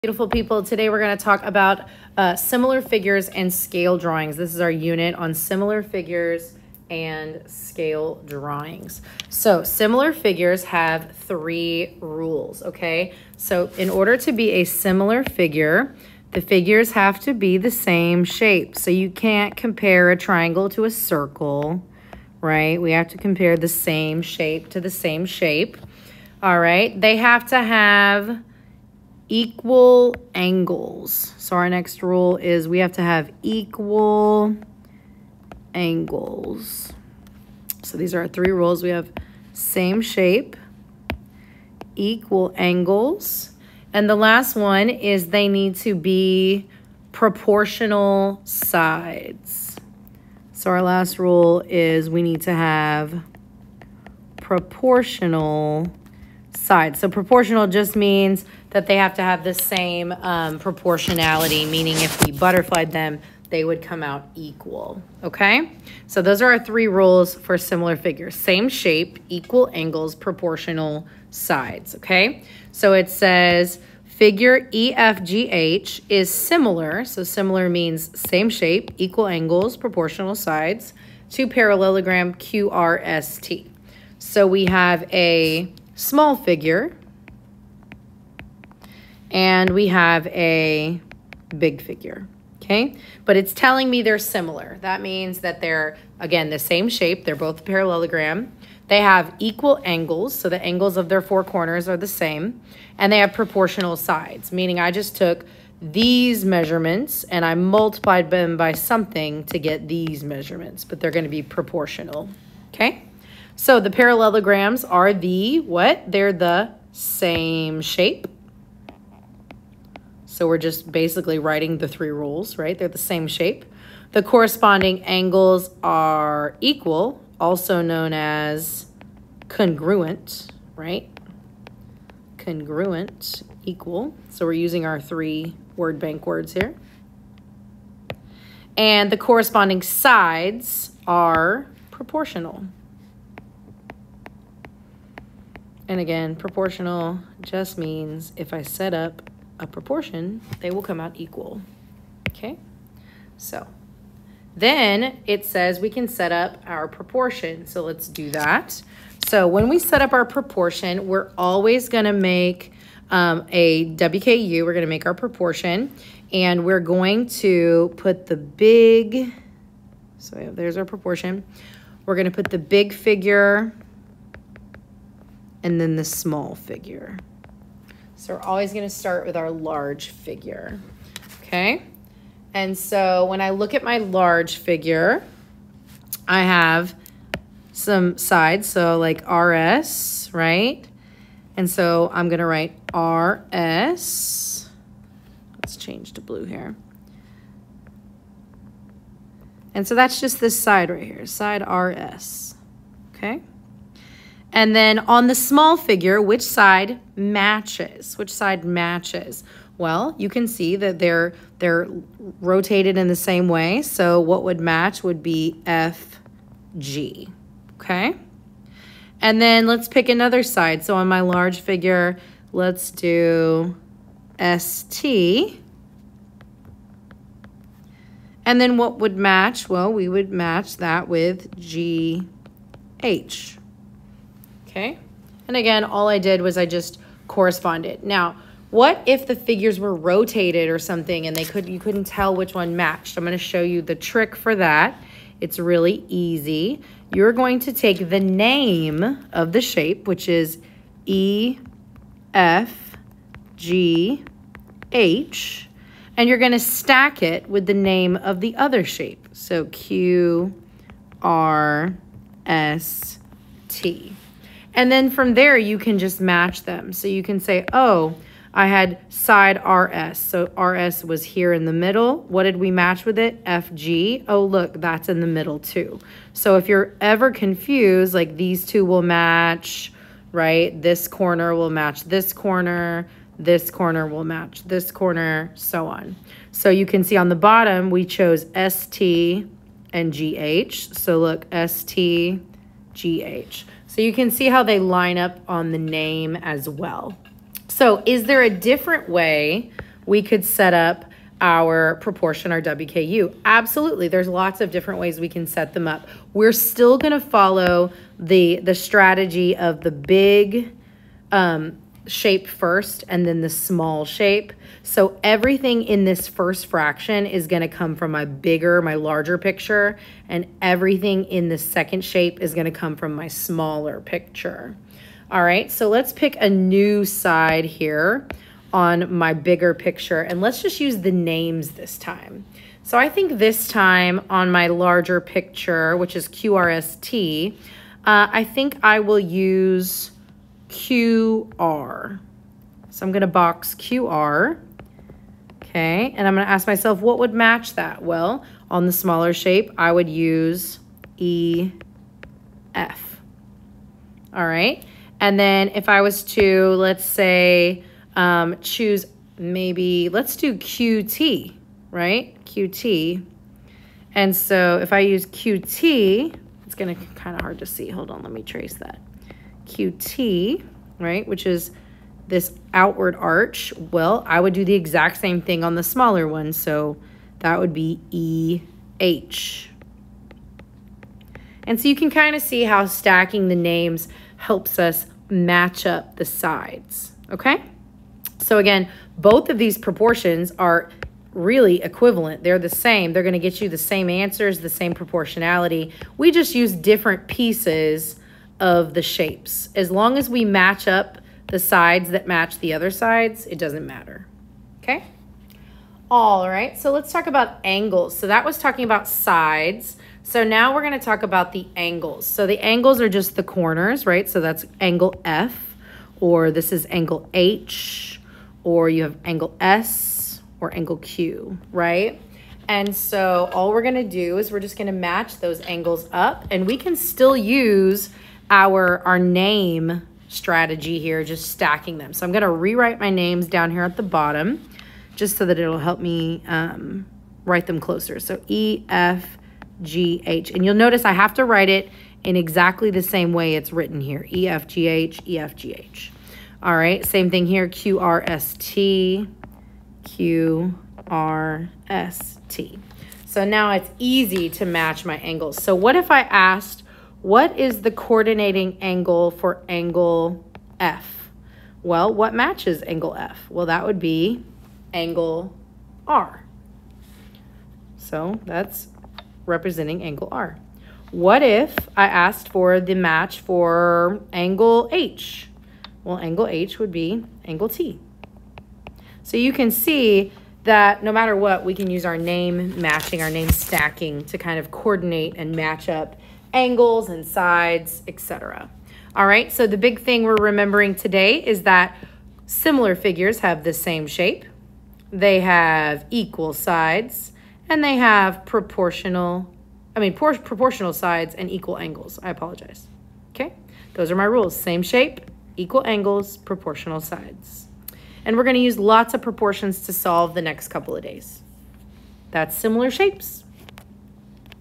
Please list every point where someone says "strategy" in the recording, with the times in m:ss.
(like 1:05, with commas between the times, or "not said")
5:08, 7:10.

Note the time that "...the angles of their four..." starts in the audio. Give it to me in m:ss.
1:40.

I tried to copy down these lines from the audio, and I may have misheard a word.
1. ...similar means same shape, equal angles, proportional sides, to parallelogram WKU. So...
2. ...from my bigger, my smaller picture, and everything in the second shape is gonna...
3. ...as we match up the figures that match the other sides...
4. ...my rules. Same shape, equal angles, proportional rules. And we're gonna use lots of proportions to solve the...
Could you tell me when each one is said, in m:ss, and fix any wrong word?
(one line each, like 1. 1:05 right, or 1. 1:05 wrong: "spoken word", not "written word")
1. 1:17 wrong: "QRST", not "WKU"
2. 5:17 wrong: "larger", not "smaller"
3. 6:40 wrong: "sides", not "figures"
4. 8:24 wrong: "sides", not "rules".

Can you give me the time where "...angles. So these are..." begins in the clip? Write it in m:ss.
0:35.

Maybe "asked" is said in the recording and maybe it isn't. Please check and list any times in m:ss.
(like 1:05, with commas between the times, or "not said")
7:36, 7:52.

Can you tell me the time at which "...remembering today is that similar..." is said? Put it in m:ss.
8:10.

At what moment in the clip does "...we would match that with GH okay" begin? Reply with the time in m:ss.
3:49.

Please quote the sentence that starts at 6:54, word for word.
So that's angle F, or this is angle H, or you have angle S, or angle Q, right?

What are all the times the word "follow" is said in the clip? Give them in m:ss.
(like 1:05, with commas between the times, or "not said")
5:07.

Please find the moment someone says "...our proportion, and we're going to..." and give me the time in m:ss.
2:45.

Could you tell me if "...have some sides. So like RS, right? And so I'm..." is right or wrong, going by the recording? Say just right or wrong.
right.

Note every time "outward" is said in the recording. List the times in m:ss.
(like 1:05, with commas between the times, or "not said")
6:12.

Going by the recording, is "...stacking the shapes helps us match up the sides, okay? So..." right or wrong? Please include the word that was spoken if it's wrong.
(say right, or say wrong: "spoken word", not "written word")
wrong: "names", not "shapes".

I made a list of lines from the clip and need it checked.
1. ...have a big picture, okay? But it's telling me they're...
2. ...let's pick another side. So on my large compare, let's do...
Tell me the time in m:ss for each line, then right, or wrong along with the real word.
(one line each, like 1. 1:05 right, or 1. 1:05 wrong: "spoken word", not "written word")
1. 1:29 wrong: "figure", not "picture"
2. 3:39 wrong: "figure", not "compare".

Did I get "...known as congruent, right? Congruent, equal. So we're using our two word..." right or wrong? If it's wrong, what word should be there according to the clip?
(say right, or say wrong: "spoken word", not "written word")
wrong: "three", not "two".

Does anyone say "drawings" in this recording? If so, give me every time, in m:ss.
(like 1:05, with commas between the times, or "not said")
0:03, 0:08.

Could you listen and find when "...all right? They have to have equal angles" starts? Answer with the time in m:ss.
0:26.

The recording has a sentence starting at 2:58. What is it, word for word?
So we're always going to start with our large figure.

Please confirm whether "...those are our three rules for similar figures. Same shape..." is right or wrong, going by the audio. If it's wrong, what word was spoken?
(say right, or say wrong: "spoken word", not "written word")
right.